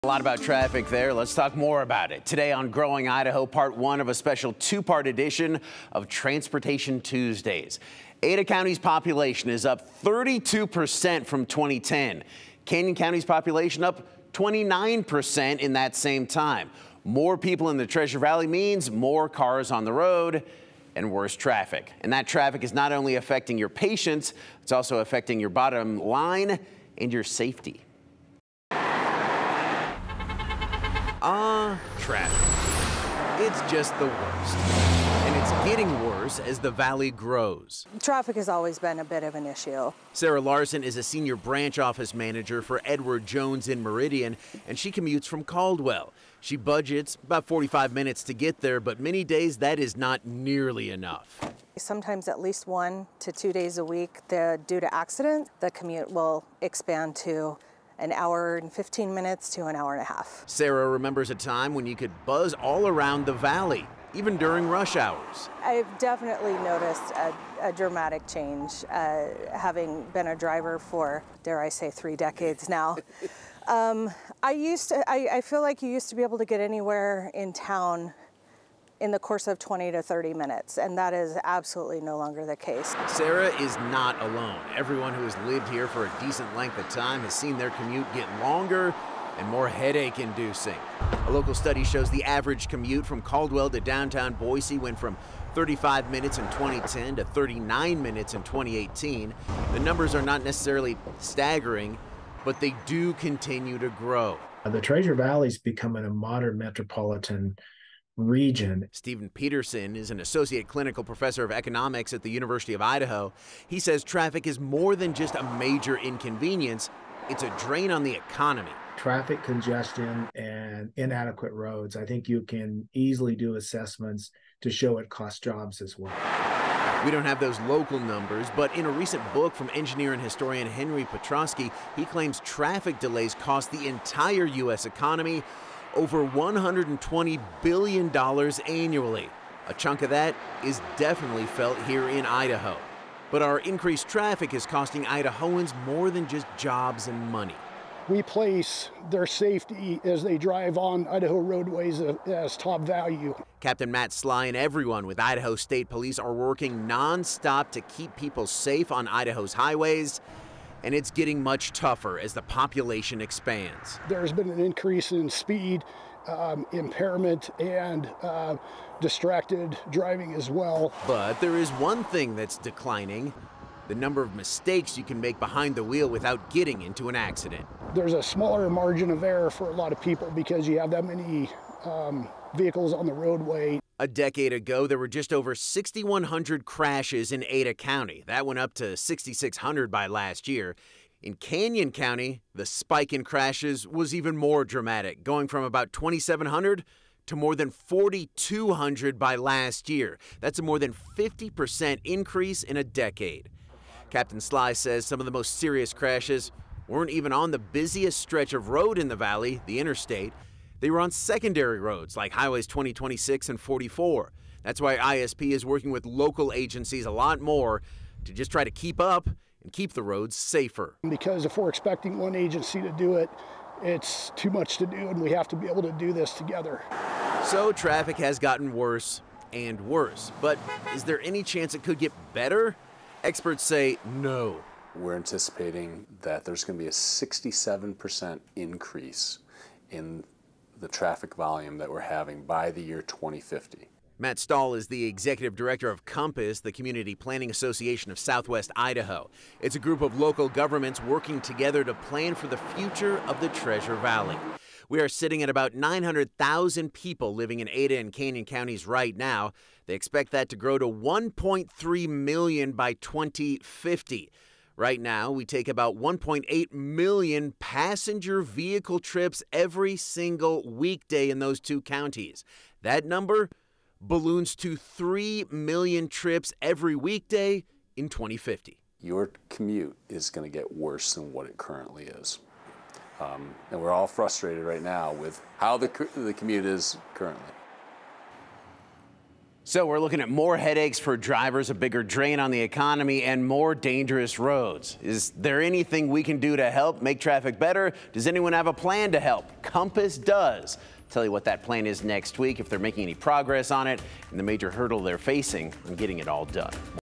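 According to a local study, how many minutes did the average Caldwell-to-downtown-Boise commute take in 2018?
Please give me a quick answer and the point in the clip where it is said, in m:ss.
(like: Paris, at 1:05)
39 minutes, at 1:37.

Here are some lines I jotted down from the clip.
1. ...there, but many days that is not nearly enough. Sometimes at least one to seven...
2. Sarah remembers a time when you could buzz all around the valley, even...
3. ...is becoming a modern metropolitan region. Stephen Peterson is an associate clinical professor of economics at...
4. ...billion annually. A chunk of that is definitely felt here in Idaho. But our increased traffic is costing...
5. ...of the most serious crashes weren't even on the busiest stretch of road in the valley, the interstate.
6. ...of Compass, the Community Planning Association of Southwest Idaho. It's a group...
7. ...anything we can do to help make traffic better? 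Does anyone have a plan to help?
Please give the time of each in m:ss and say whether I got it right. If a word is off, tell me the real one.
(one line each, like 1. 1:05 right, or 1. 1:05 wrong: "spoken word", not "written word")
1. 0:48 wrong: "two", not "seven"
2. 1:00 right
3. 1:45 right
4. 2:17 right
5. 3:25 right
6. 4:05 right
7. 4:55 right.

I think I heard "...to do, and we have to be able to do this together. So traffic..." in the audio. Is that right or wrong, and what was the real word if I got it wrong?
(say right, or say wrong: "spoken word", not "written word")
right.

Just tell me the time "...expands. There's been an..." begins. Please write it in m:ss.
2:43.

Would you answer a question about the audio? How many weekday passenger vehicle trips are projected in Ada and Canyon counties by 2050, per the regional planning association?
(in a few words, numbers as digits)
3 million.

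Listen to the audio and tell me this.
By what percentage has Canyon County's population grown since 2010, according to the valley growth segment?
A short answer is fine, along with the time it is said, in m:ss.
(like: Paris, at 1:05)
29%, at 0:14.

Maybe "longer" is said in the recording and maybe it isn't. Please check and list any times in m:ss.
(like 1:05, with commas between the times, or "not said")
1:22, 1:28.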